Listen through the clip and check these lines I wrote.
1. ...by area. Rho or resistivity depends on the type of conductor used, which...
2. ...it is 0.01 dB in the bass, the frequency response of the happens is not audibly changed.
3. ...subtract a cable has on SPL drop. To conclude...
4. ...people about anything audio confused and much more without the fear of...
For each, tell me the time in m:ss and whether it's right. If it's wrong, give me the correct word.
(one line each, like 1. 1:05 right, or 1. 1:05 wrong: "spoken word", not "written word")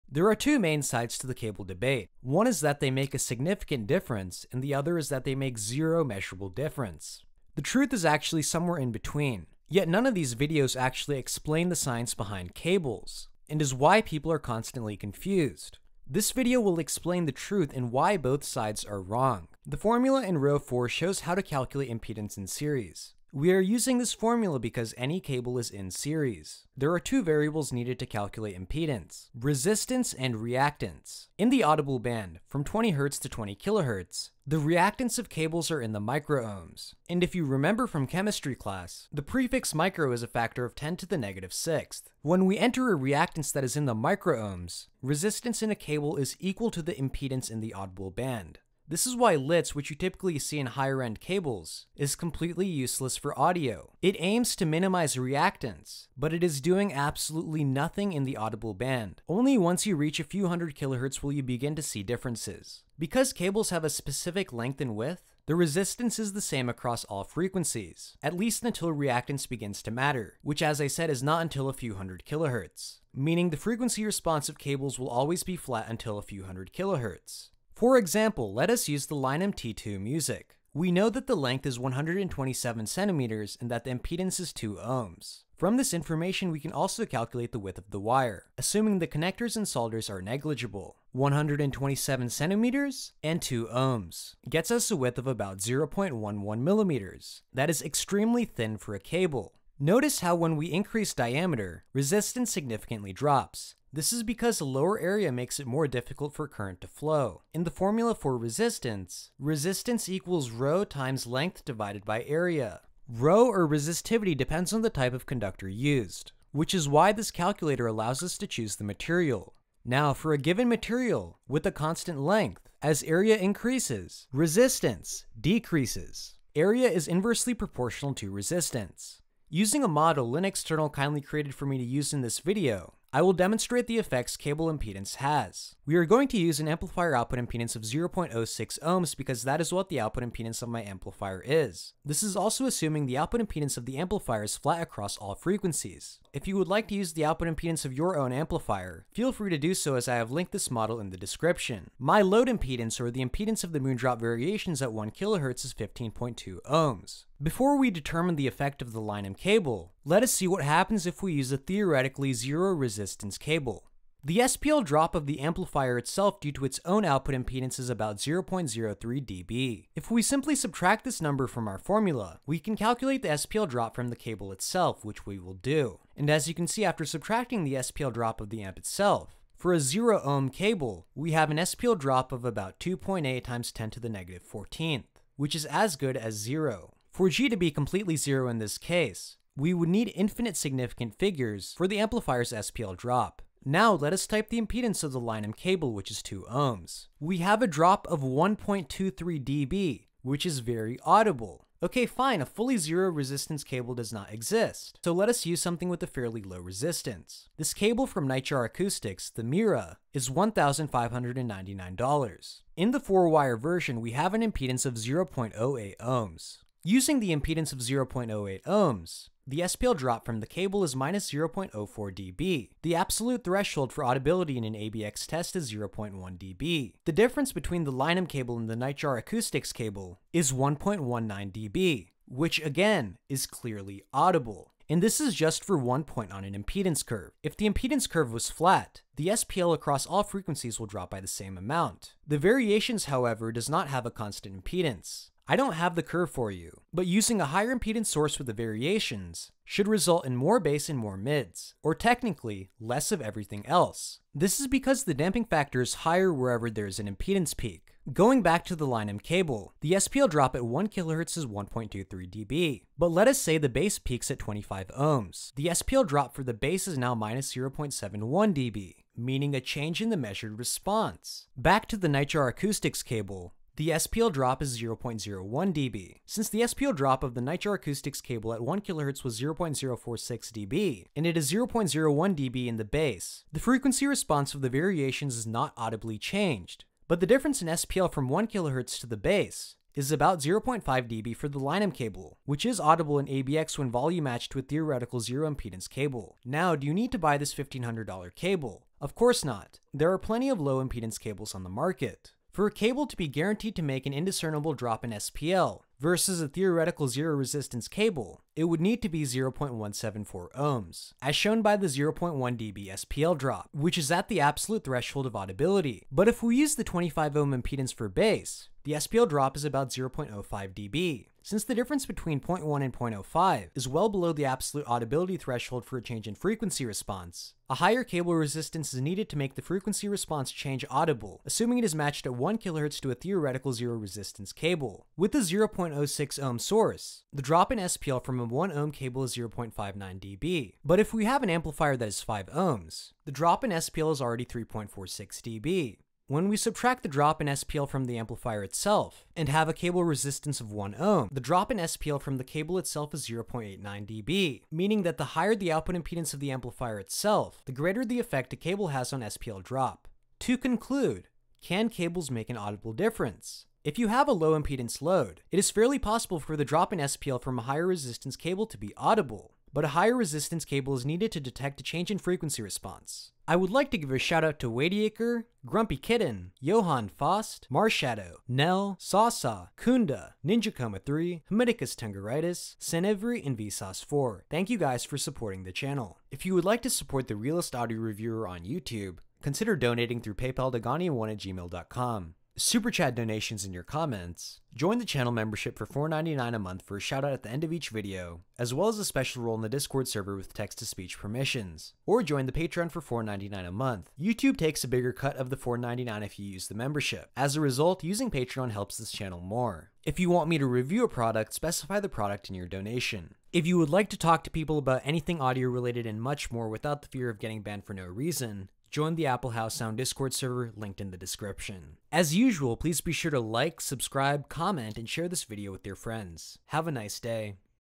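1. 1:52 right
2. 4:41 wrong: "variations", not "happens"
3. 5:58 wrong: "effect", not "subtract"
4. 6:54 wrong: "related", not "confused".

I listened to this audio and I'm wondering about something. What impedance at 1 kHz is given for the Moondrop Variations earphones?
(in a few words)
15.2 ohms.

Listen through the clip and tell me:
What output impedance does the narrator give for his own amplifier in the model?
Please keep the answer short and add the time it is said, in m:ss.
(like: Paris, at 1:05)
0.06 ohms, at 2:17.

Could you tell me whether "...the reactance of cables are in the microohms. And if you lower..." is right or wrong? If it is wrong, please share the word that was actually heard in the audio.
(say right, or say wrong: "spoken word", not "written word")
wrong: "remember", not "lower".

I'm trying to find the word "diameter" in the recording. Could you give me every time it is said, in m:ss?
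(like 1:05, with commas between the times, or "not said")
1:41.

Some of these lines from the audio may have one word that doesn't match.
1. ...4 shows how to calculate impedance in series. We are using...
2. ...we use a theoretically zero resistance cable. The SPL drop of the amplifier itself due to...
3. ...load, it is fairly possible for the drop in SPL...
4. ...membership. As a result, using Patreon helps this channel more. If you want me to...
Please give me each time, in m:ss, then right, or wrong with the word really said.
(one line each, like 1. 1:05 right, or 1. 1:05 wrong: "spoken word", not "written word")
1. 0:20 right
2. 2:41 right
3. 6:05 right
4. 6:46 right.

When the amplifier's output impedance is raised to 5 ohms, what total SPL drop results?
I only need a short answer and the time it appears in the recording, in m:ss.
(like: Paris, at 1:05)
3.46 dB, at 5:44.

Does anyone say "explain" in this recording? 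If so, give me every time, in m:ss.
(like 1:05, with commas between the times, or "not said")
0:11, 0:16.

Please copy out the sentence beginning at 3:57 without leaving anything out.
If the impedance curve was flat, the SPL across all frequencies will drop by the same amount.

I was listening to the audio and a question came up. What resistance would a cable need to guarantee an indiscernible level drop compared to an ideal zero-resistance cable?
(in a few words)
0.174 ohms.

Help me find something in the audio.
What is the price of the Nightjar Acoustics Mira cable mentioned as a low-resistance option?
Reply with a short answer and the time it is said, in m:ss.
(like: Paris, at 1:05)
$1,599, at 3:30.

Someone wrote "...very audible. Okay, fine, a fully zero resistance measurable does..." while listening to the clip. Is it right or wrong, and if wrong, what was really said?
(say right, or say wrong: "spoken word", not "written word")
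wrong: "cable", not "measurable".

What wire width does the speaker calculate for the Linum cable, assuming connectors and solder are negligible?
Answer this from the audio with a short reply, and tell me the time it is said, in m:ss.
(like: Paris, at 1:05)
0.11 millimeters, at 1:35.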